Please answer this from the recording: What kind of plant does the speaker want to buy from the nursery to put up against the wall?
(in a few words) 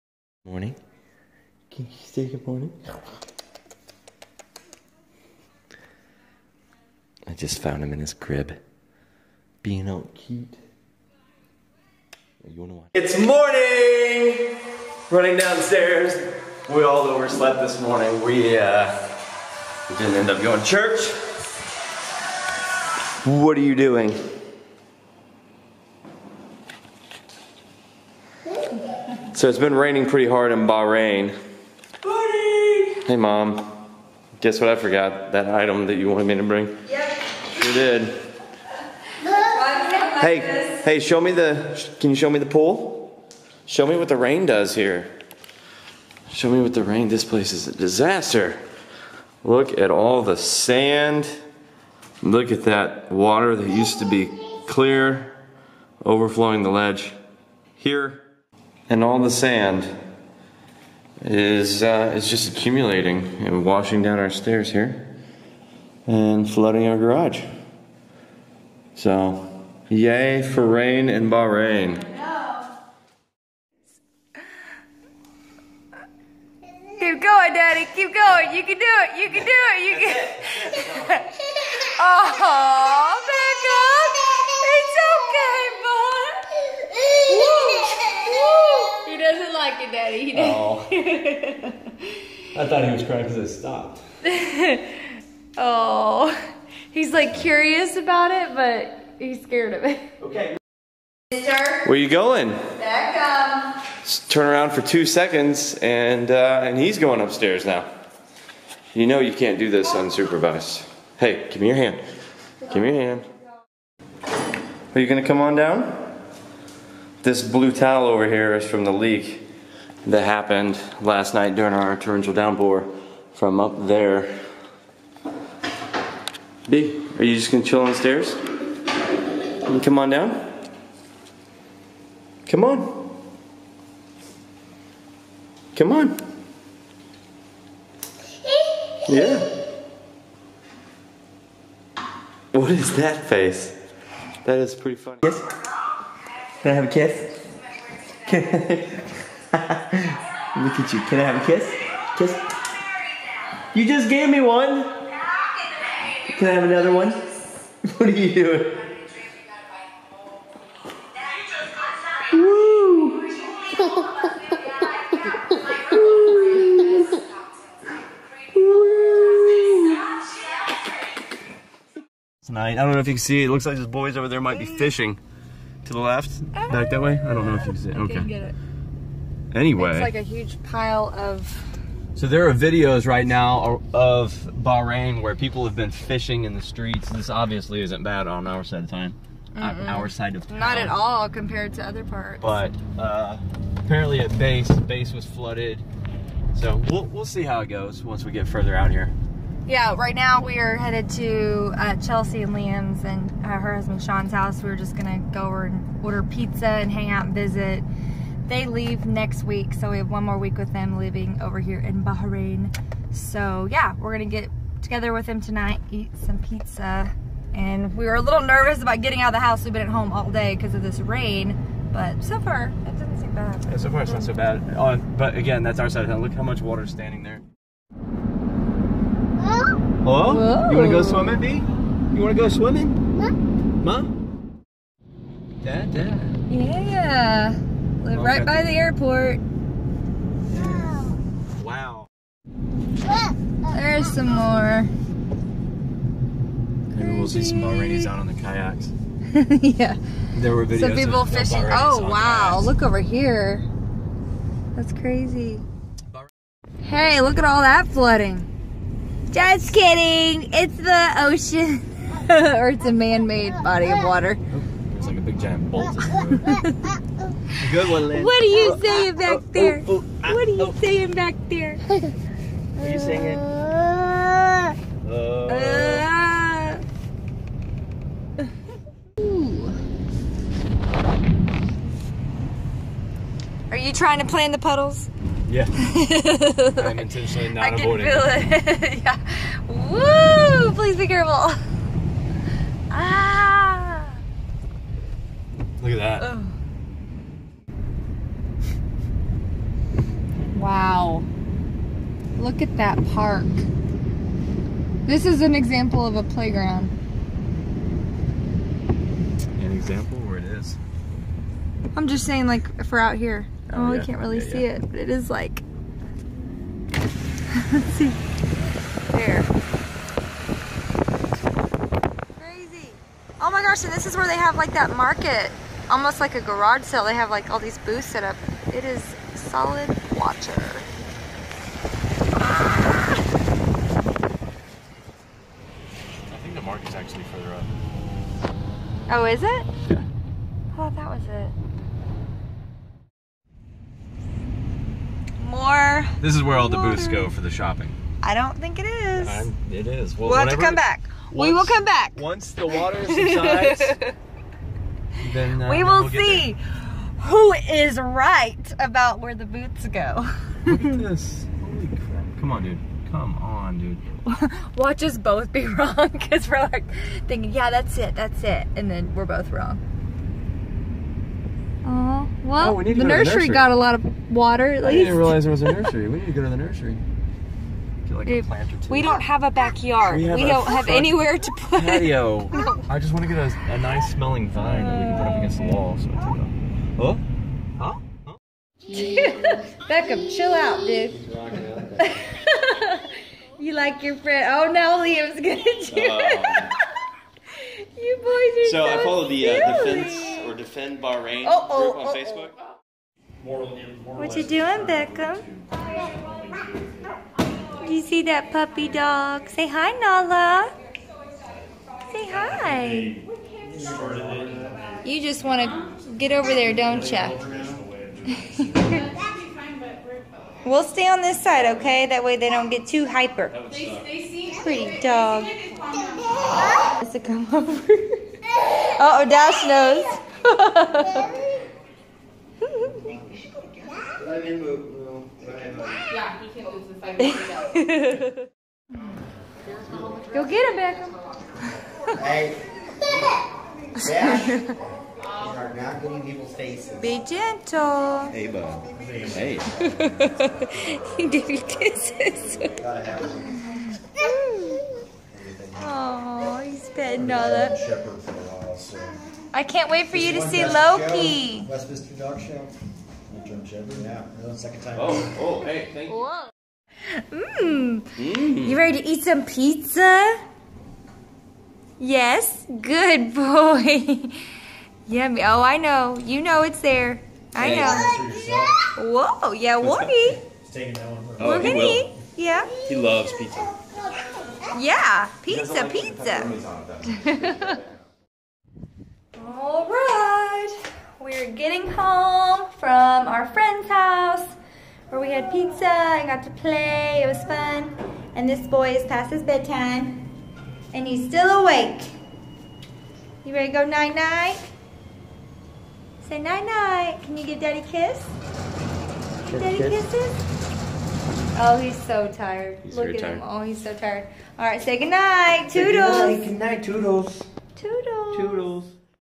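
a nice smelling vine.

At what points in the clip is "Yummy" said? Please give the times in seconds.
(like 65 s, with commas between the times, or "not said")
475 s.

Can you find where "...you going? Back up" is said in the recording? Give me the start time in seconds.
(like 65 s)
101 s.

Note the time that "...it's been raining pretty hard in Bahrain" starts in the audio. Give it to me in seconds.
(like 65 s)
29 s.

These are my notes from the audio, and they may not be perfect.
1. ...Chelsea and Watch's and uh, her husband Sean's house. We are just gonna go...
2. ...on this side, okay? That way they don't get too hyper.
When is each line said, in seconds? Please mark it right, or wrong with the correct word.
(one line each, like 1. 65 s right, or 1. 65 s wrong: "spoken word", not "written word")
1. 202 s wrong: "Liam", not "Watch"
2. 421 s right.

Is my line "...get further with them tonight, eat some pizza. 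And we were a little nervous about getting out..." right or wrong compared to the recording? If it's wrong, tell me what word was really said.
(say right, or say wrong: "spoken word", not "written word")
wrong: "together", not "further".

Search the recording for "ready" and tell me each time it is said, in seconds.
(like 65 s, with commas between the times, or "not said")
468 s, 503 s.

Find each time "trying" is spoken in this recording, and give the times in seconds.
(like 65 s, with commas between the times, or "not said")
283 s.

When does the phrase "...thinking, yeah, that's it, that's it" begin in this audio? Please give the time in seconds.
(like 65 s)
367 s.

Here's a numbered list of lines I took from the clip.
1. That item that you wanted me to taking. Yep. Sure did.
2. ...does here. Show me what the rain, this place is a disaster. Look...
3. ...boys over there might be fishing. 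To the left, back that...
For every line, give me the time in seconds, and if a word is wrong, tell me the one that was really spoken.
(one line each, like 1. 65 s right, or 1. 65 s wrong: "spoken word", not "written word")
1. 35 s wrong: "bring", not "taking"
2. 44 s right
3. 173 s right.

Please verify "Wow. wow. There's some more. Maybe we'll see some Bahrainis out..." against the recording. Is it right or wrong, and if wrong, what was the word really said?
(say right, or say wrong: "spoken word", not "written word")
right.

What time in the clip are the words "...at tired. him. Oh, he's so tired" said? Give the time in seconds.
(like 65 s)
513 s.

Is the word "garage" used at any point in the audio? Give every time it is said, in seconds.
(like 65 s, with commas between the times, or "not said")
66 s, 326 s.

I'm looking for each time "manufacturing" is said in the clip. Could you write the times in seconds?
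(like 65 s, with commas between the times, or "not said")
not said.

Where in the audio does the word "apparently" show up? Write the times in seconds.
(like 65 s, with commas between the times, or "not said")
193 s.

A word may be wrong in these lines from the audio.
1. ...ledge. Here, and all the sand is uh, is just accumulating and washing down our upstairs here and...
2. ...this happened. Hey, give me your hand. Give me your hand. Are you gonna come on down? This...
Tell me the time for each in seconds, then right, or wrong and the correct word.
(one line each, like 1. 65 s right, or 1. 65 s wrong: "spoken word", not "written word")
1. 56 s wrong: "stairs", not "upstairs"
2. 109 s wrong: "unsupervised", not "happened".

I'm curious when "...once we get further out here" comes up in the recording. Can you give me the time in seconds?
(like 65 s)
198 s.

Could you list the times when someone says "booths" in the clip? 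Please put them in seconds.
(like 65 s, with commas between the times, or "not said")
327 s, 346 s, 359 s.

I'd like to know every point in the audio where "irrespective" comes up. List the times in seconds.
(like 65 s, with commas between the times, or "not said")
not said.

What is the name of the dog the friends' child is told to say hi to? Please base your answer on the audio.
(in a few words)
Nala.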